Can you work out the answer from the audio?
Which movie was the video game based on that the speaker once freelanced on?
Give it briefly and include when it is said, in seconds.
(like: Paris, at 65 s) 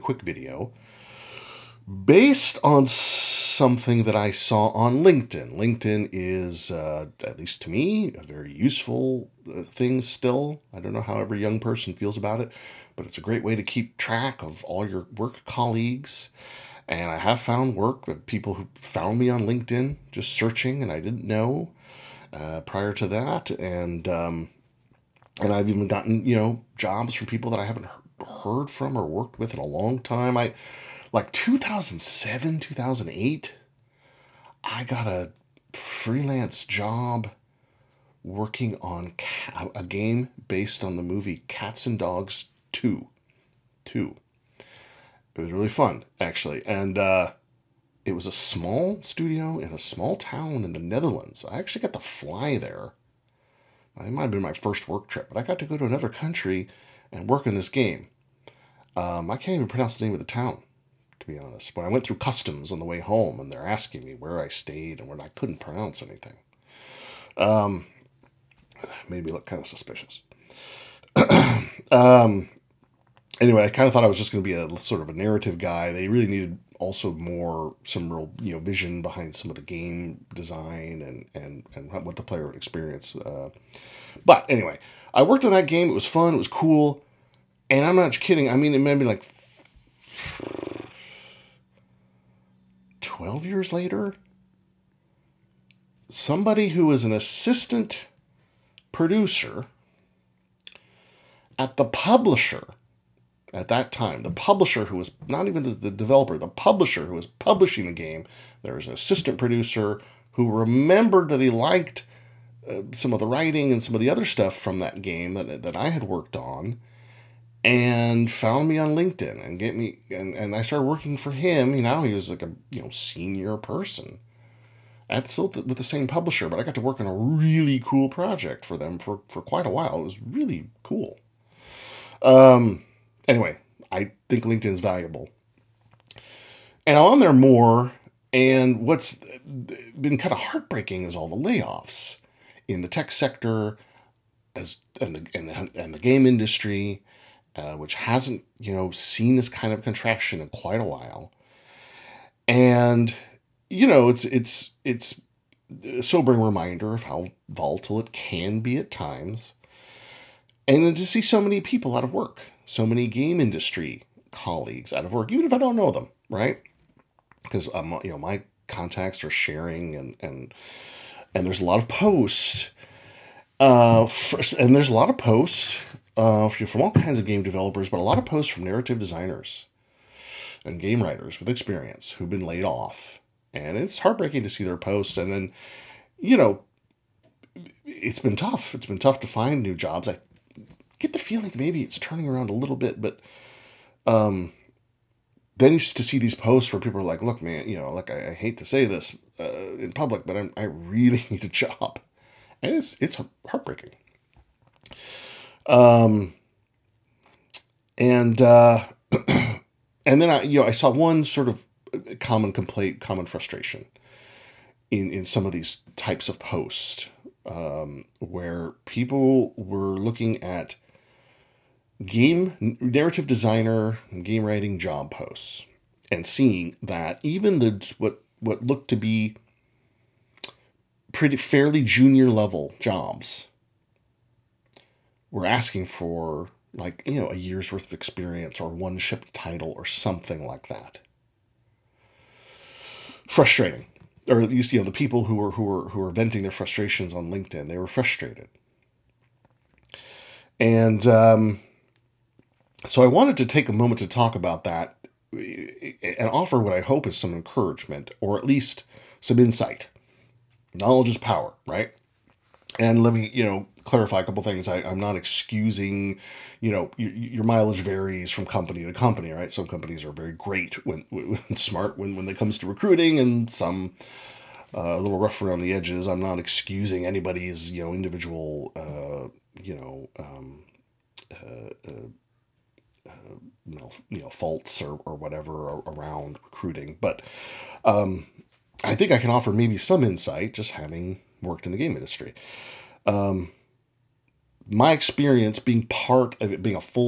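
Cats and Dogs 2, at 41 s.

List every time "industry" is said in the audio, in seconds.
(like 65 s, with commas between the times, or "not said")
146 s, 163 s, 291 s.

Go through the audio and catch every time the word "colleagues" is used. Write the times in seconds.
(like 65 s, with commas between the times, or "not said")
15 s, 164 s.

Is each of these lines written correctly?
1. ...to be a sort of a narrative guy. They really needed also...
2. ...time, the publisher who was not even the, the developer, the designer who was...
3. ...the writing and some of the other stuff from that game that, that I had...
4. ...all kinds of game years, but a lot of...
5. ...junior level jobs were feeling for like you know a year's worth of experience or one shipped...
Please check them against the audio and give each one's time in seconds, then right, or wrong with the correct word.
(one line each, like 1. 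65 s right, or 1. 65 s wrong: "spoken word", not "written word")
1. 74 s right
2. 103 s wrong: "publisher", not "designer"
3. 113 s right
4. 176 s wrong: "developers", not "years"
5. 231 s wrong: "asking", not "feeling".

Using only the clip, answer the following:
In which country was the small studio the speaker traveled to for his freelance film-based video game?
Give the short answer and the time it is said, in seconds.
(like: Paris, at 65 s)
the Netherlands, at 50 s.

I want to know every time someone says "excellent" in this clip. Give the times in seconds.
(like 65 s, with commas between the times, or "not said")
not said.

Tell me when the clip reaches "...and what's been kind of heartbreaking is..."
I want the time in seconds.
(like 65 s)
138 s.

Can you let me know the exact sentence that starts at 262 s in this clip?
And let me, you know, clarify a couple things.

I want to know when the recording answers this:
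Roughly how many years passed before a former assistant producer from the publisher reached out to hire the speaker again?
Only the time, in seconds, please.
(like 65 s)
93 s.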